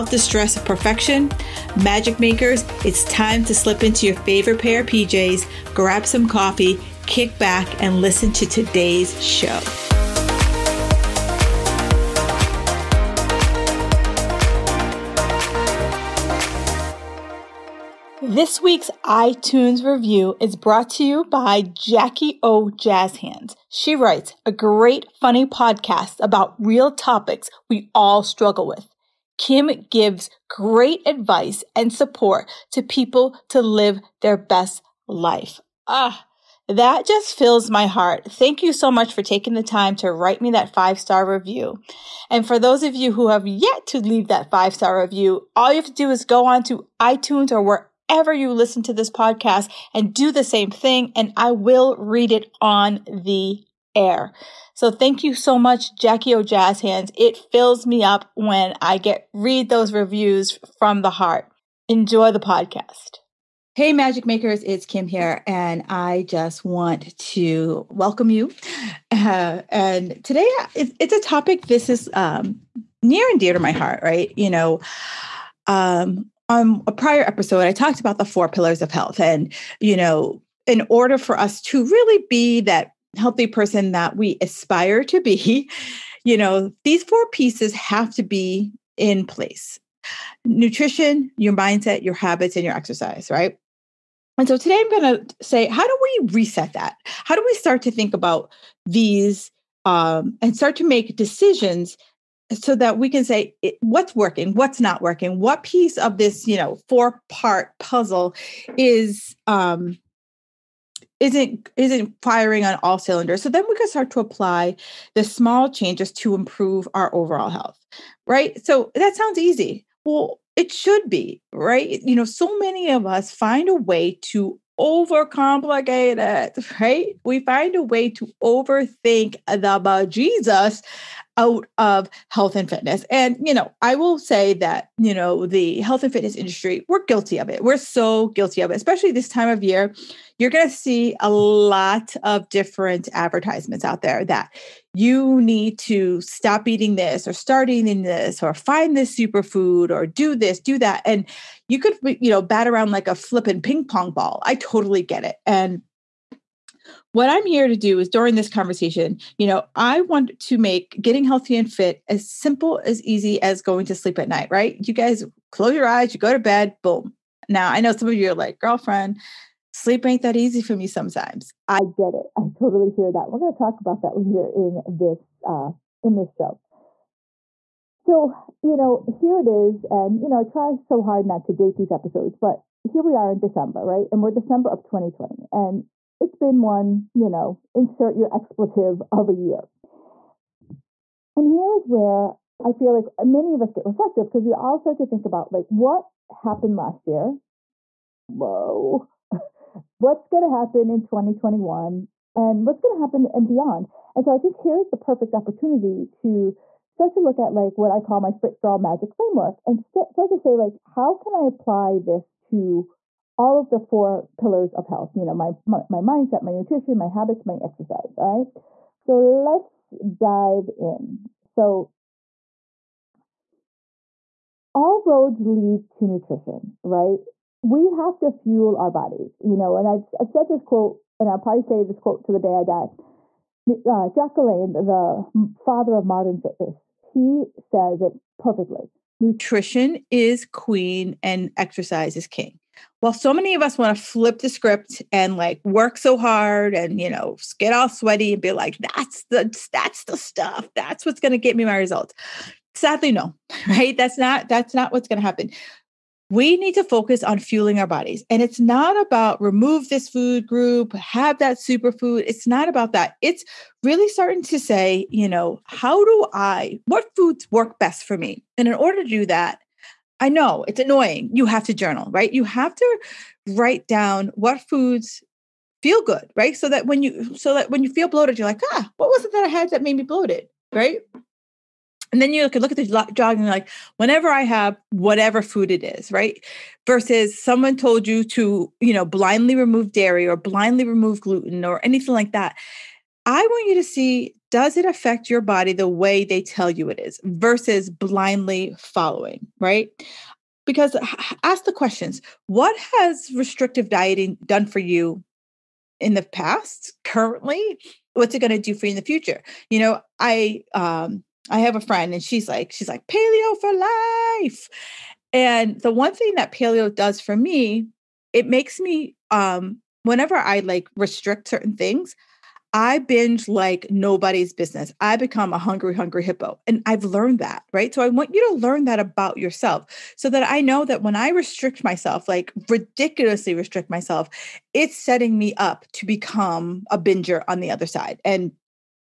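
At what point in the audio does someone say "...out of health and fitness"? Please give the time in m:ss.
2:11.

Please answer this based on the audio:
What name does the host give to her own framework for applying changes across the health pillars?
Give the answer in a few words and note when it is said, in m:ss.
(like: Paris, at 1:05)
Fit Girl magic framework, at 3:28.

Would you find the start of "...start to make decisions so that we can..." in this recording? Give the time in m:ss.
1:40.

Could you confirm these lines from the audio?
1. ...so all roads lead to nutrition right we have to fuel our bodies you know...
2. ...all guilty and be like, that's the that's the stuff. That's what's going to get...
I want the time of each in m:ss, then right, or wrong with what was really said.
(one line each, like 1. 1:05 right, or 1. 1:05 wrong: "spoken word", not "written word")
1. 3:41 right
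2. 4:07 wrong: "sweaty", not "guilty".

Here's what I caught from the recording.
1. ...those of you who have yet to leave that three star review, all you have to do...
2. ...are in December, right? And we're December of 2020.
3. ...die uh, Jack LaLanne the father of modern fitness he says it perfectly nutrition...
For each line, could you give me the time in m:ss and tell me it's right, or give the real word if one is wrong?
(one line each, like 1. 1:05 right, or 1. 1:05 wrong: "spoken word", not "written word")
1. 0:42 wrong: "five", not "three"
2. 3:03 right
3. 3:52 right.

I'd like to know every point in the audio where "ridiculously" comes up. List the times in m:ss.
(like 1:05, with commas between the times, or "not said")
5:32.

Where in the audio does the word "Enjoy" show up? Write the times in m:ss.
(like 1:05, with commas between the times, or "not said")
1:01.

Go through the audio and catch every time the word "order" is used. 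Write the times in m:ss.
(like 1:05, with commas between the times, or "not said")
1:20, 4:28.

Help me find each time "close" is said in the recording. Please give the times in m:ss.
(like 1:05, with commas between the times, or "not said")
2:45.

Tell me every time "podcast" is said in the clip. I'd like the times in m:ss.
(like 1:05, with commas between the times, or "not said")
0:25, 0:49, 1:02.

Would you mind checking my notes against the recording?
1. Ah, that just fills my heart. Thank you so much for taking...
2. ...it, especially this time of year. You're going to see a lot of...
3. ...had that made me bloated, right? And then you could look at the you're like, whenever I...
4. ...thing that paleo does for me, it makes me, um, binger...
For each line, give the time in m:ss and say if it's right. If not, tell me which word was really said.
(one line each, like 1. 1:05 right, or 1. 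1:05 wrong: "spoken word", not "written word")
1. 0:35 right
2. 2:18 right
3. 4:39 right
4. 5:16 wrong: "whenever", not "binger".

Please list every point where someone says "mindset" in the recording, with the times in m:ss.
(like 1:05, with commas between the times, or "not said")
1:31, 3:36.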